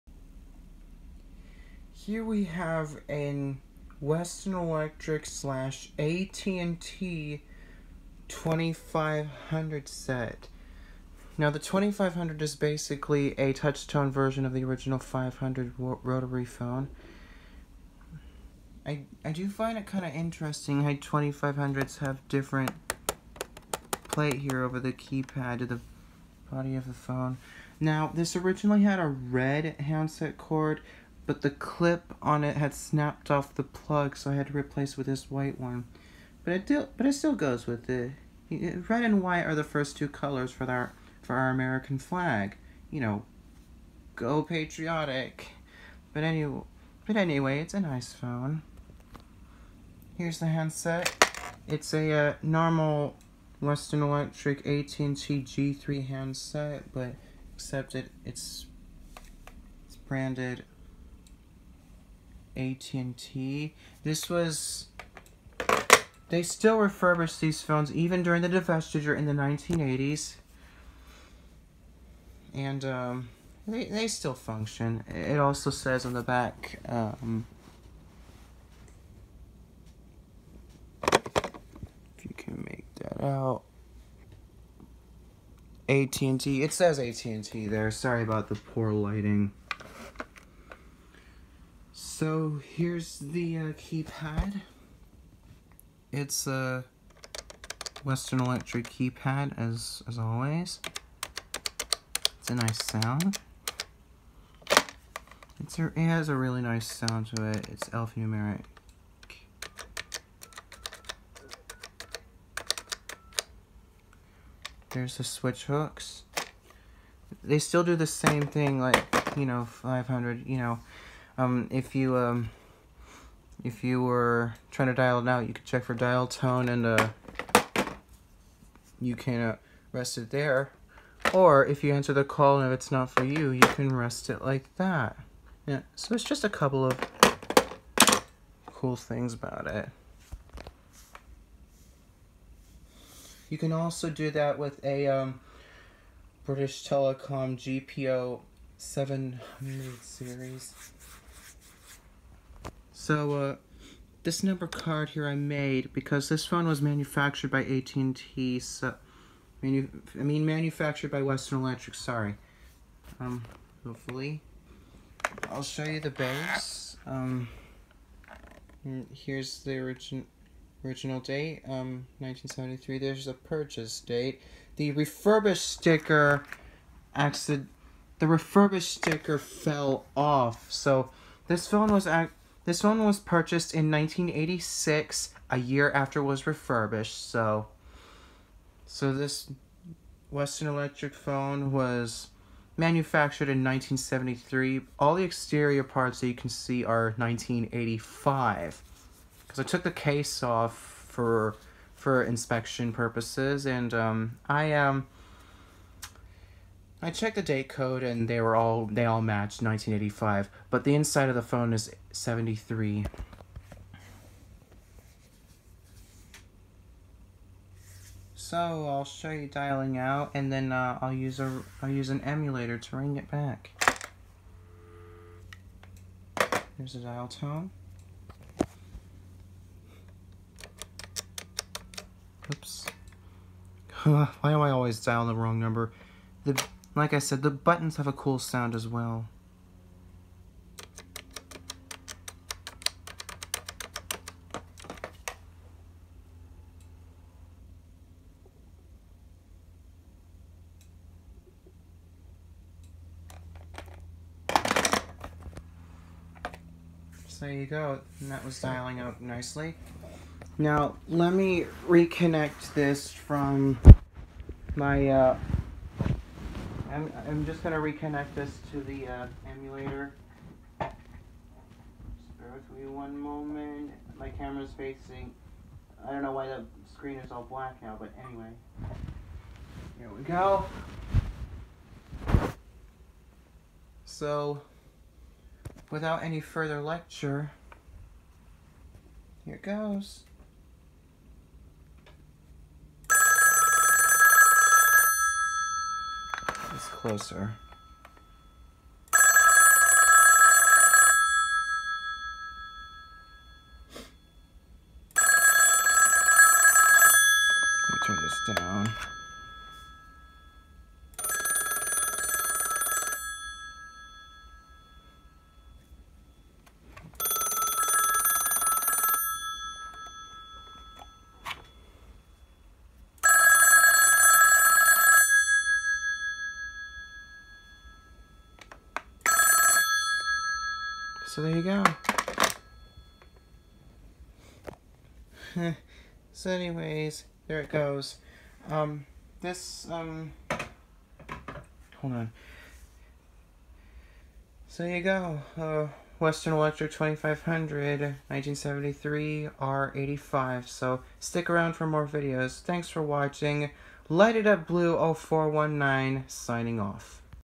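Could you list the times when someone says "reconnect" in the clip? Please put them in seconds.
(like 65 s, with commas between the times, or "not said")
261 s, 267 s.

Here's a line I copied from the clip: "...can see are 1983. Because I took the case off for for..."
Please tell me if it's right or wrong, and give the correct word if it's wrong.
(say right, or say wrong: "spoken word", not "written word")
wrong: "1985", not "1983".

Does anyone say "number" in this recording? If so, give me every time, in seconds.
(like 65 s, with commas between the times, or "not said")
154 s, 235 s.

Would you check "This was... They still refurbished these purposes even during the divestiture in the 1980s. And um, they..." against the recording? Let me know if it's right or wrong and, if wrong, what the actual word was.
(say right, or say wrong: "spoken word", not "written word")
wrong: "phones", not "purposes".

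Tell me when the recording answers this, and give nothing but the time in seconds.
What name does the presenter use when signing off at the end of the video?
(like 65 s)
354 s.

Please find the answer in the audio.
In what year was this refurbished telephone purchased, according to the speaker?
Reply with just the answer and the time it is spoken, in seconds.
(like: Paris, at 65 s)
1986, at 183 s.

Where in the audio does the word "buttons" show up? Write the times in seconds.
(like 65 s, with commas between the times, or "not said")
237 s.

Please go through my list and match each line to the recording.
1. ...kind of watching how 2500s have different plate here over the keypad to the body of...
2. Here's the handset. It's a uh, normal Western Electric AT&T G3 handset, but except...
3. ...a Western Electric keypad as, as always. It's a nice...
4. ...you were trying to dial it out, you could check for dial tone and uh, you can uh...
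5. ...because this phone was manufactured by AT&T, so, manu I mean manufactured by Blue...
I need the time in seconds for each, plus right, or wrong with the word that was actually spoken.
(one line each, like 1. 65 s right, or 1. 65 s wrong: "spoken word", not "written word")
1. 19 s wrong: "interesting", not "watching"
2. 50 s right
3. 96 s right
4. 123 s right
5. 155 s wrong: "Western", not "Blue".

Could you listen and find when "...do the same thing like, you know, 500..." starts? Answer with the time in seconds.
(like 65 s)
117 s.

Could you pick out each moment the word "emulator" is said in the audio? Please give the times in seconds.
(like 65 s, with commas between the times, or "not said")
222 s, 269 s.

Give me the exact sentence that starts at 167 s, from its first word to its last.
Um, here's the original, original date, um, 1973.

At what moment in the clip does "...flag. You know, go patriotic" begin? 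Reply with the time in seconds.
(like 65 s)
41 s.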